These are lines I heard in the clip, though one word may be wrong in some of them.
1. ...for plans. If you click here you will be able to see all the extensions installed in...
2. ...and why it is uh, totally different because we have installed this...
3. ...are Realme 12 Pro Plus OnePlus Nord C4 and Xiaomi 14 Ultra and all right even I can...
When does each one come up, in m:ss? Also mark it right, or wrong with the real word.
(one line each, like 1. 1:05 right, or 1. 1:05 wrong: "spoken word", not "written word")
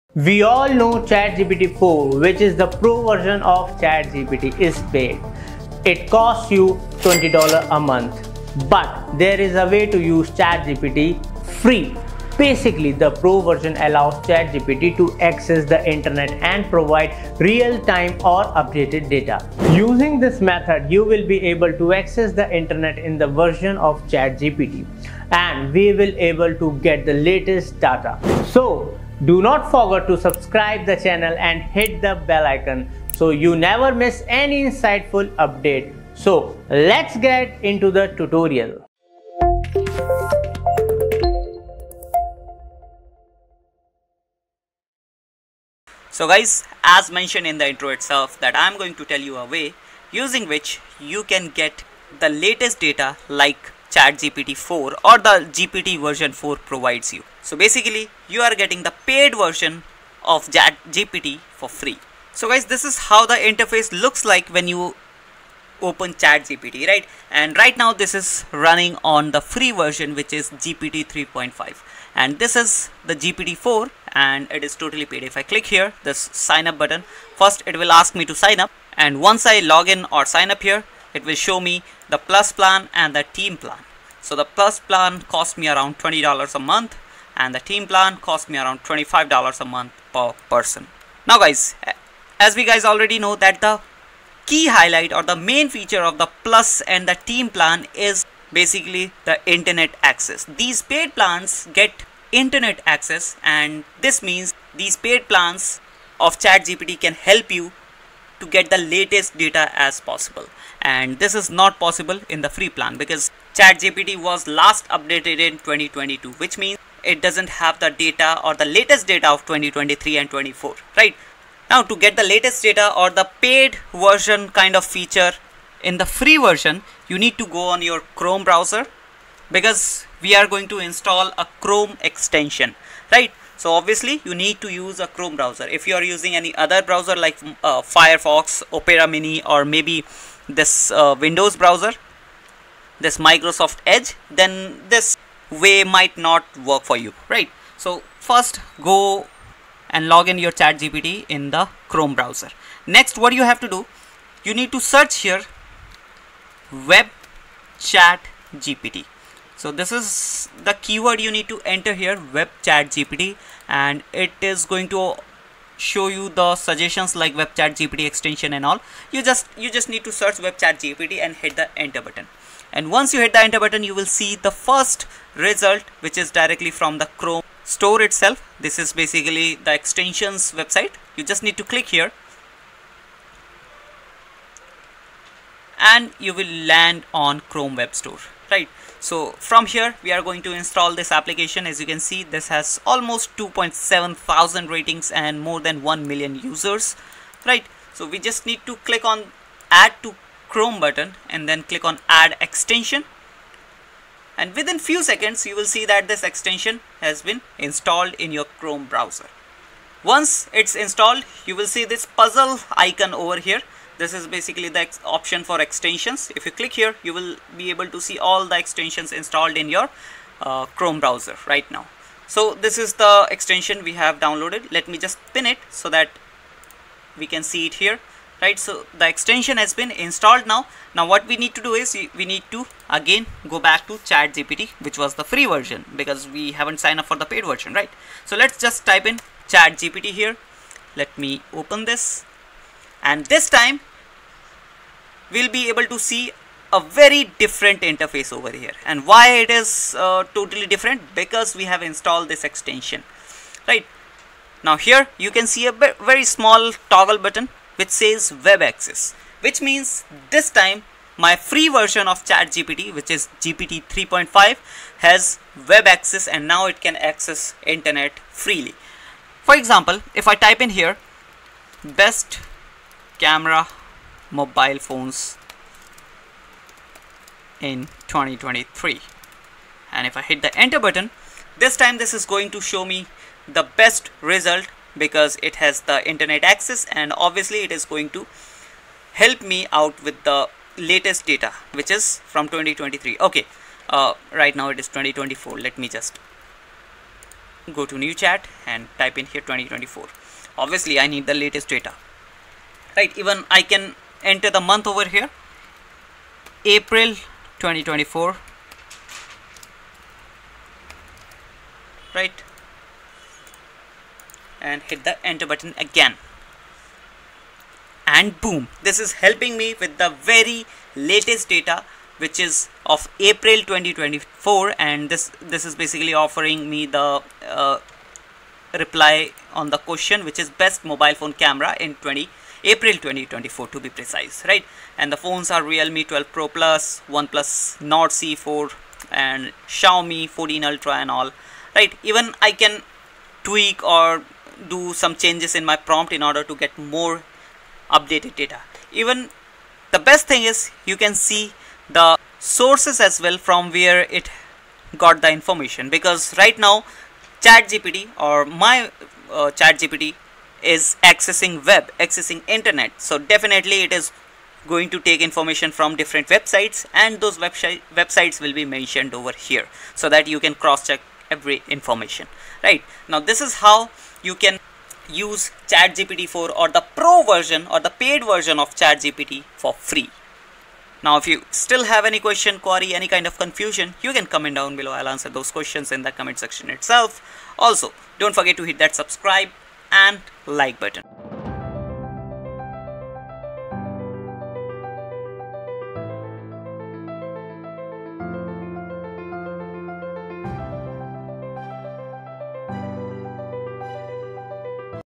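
1. 3:35 wrong: "extensions", not "plans"
2. 4:08 right
3. 5:35 right.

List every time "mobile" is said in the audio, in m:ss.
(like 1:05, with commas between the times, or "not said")
4:34, 5:30.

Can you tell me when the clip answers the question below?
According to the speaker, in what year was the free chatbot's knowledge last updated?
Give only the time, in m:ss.
1:55.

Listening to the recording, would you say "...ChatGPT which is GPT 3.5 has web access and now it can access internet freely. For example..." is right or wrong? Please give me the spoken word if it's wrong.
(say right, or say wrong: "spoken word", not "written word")
right.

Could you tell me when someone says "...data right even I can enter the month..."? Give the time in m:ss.
5:01.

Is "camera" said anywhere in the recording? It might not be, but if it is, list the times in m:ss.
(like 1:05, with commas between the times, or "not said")
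4:33, 5:31.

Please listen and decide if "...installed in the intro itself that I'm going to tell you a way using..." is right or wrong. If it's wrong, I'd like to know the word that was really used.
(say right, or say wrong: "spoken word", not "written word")
wrong: "mentioned", not "installed".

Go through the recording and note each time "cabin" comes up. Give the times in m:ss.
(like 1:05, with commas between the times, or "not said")
not said.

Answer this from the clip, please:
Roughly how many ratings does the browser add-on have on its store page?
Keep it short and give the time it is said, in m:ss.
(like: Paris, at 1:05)
2.7 thousand, at 3:13.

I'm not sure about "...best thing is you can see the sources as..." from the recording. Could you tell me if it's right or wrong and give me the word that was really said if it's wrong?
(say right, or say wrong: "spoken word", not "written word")
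right.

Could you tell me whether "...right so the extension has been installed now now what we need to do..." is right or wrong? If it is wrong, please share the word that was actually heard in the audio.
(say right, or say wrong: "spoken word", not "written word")
right.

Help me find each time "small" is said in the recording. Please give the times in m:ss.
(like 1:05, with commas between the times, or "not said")
4:16.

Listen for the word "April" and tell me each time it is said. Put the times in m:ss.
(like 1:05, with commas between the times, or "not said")
5:06, 5:23, 5:32.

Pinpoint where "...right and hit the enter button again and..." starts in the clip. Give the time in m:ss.
5:12.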